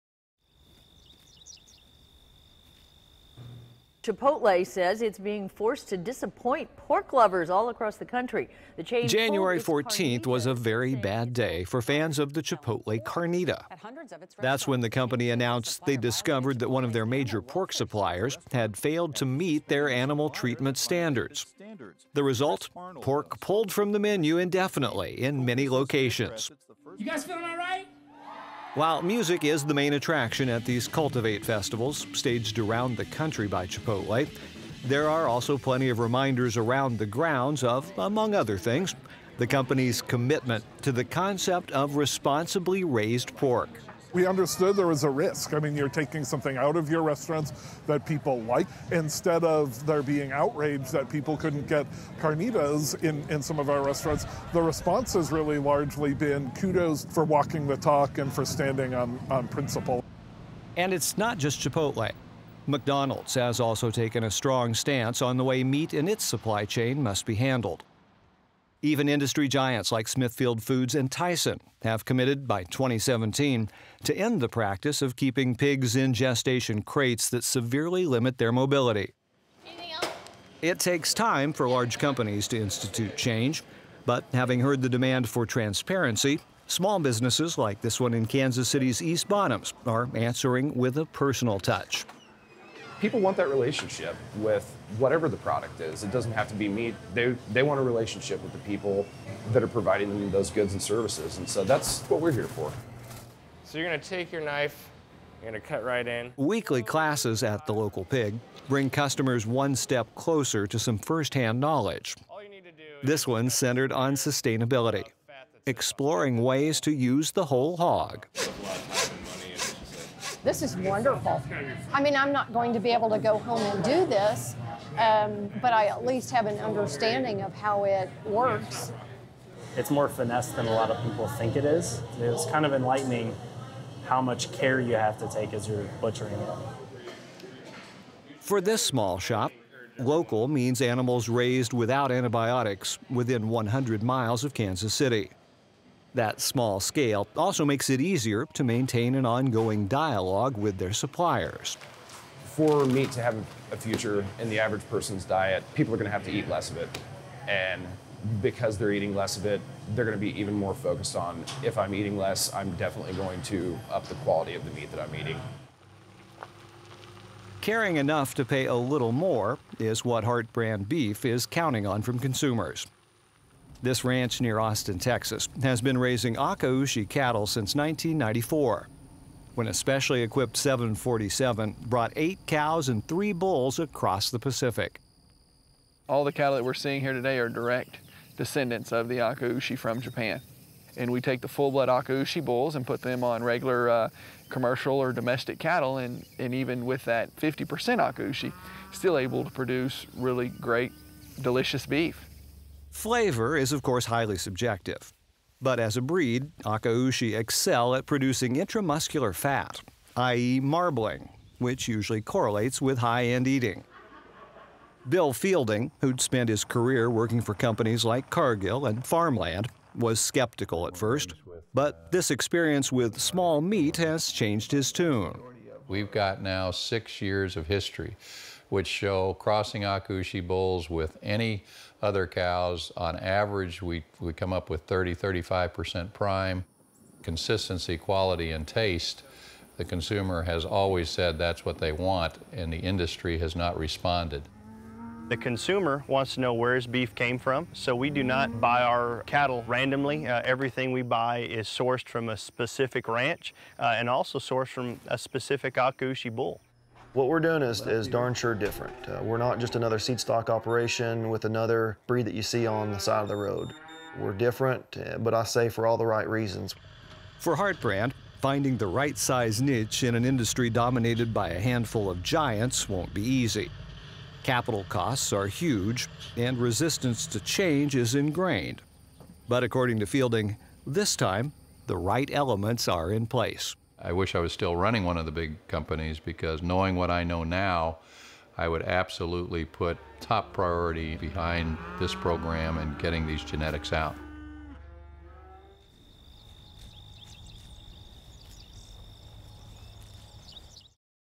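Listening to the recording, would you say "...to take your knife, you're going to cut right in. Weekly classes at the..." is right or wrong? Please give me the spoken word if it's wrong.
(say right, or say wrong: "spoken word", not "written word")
right.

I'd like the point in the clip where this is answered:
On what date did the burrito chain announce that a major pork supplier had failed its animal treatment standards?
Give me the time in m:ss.
0:09.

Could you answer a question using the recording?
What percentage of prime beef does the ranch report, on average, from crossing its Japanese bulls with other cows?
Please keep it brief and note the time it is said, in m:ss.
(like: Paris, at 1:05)
30-35%, at 3:54.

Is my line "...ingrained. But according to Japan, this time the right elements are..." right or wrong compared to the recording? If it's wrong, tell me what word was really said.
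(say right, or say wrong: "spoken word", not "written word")
wrong: "Fielding", not "Japan".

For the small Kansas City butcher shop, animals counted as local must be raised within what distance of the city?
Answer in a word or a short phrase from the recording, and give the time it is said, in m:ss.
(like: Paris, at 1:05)
100 miles, at 2:23.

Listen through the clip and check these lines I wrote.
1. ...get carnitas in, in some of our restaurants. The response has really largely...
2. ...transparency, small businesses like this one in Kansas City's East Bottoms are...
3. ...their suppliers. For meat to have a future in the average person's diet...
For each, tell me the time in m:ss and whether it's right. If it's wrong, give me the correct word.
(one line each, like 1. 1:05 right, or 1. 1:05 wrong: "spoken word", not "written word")
1. 0:51 right
2. 1:25 right
3. 2:30 right.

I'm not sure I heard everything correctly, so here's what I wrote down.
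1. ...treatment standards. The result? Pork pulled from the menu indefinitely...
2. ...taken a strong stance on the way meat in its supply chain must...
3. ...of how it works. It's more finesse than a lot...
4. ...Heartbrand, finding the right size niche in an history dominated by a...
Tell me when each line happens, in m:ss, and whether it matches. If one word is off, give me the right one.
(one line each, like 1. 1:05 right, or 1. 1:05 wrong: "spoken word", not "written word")
1. 0:20 right
2. 1:03 right
3. 2:07 right
4. 4:27 wrong: "industry", not "history".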